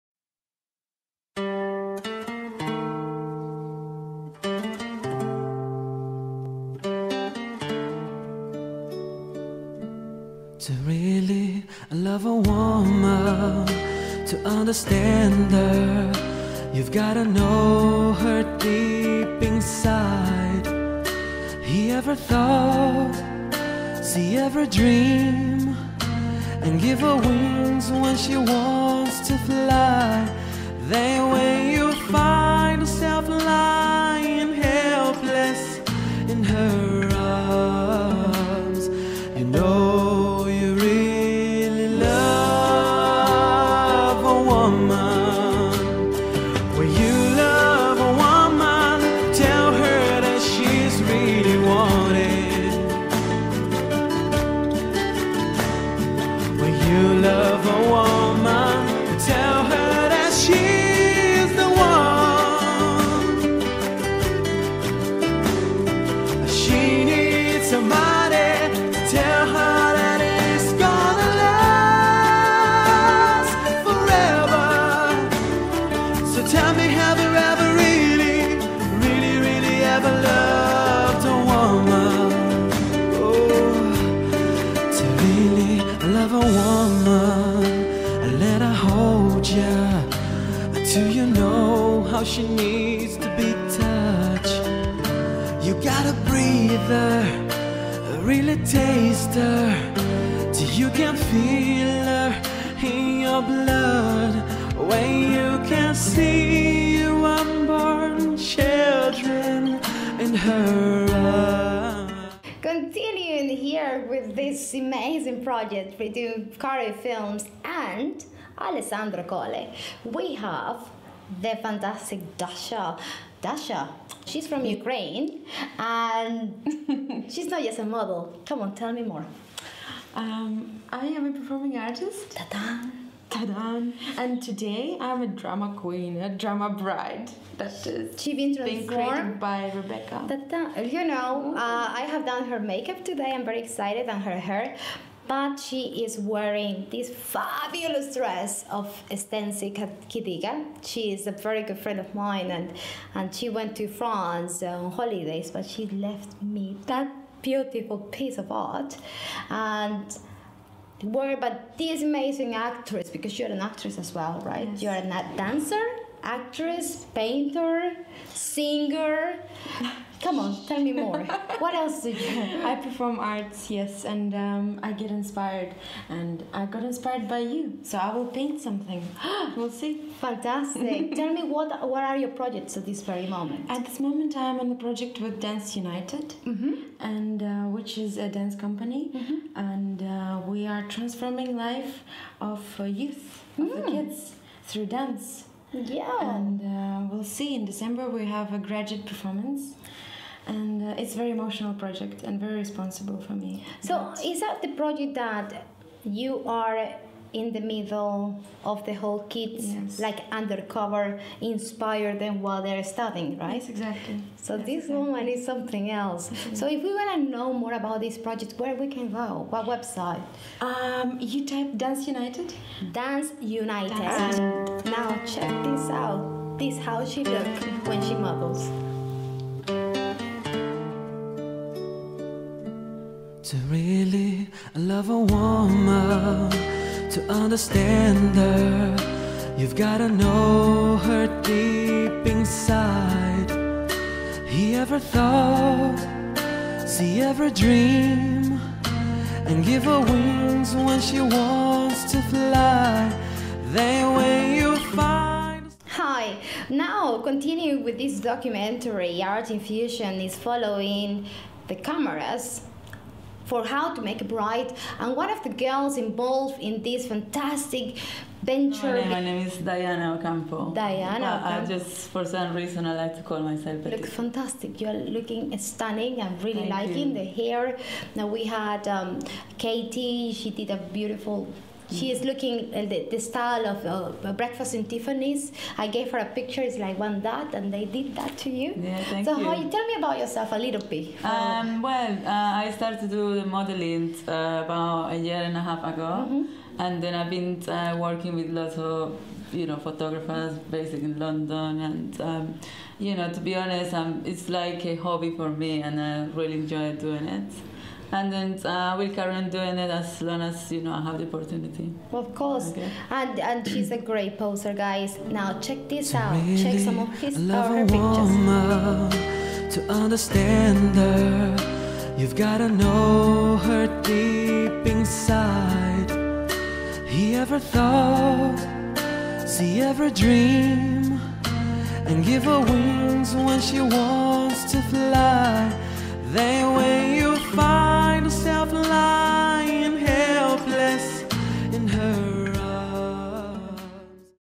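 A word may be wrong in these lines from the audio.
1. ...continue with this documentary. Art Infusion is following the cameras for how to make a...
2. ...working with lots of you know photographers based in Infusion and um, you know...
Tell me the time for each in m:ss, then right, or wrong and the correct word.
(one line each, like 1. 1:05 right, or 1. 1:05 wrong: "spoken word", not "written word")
1. 4:17 right
2. 4:57 wrong: "London", not "Infusion".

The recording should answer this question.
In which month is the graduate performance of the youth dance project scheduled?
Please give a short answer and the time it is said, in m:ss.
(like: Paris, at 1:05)
December, at 3:17.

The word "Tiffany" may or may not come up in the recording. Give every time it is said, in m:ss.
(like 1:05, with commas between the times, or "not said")
4:44.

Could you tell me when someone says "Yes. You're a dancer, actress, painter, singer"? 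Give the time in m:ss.
2:44.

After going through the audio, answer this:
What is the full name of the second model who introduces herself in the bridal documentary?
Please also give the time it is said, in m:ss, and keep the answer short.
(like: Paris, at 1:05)
Diana Ocampo, at 4:29.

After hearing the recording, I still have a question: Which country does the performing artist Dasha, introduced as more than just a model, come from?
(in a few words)
Ukraine.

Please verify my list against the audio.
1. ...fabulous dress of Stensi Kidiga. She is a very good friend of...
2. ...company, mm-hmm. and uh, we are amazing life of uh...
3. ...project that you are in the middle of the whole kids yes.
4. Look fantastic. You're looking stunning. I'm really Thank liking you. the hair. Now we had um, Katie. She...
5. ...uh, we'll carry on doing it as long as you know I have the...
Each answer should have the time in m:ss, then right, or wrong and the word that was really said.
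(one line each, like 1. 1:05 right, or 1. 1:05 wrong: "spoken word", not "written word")
1. 2:27 right
2. 3:08 wrong: "transforming", not "amazing"
3. 3:24 right
4. 4:33 right
5. 5:08 right.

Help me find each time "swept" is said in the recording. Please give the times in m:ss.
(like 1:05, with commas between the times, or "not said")
not said.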